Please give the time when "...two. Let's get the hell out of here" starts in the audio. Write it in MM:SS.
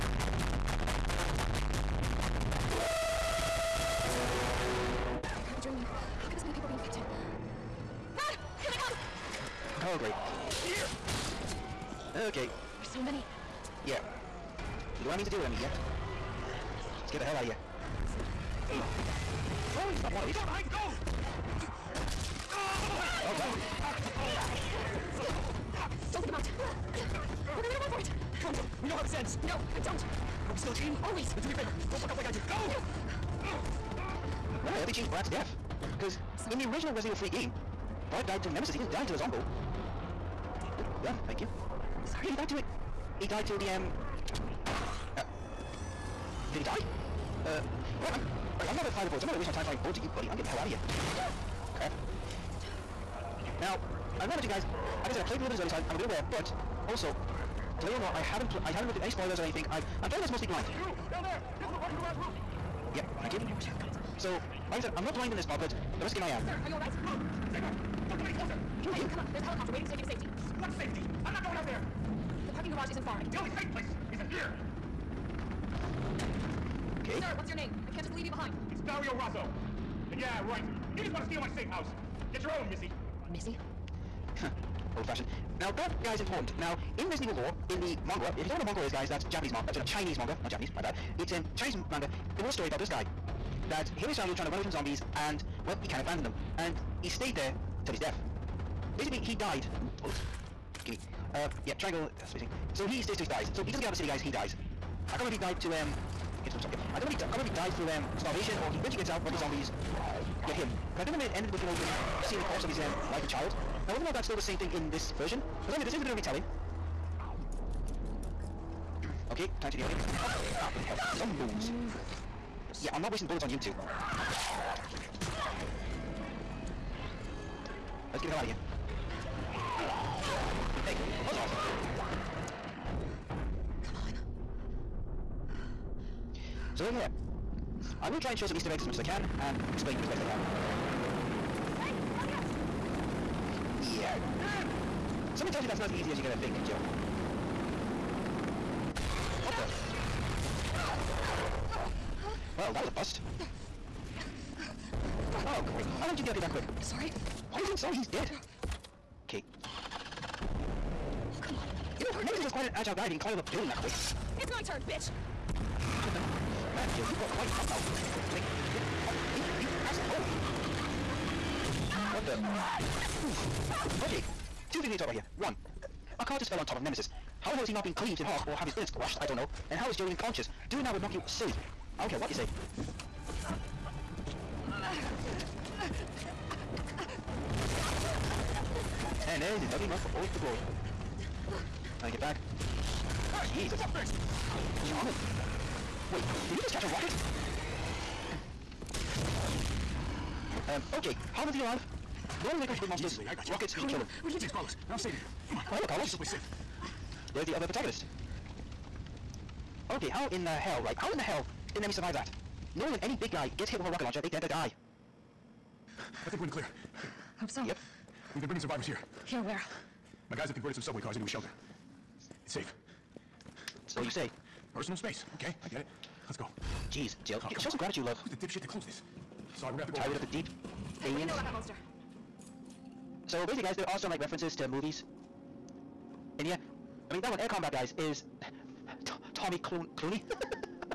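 02:03.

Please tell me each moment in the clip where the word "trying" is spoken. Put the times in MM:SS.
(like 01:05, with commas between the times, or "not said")
01:34, 03:12.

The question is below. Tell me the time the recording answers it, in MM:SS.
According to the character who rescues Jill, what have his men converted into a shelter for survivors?
03:40.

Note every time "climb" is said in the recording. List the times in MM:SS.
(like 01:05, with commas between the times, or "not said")
02:43.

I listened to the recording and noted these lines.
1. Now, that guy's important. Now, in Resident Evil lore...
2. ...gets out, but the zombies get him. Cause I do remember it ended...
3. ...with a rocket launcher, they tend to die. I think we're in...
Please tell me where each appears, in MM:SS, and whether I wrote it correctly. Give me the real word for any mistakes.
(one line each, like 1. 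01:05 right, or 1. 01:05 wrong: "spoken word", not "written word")
1. 01:25 right
2. 01:48 right
3. 03:33 right.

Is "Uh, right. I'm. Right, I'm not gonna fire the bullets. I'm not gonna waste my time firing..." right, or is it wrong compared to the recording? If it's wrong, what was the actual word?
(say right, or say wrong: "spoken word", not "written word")
right.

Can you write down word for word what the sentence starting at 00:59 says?
I've I'm playing this mostly blind.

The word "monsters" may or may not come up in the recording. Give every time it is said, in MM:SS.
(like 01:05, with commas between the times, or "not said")
03:22, 03:51.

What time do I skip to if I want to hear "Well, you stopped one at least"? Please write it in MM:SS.
00:19.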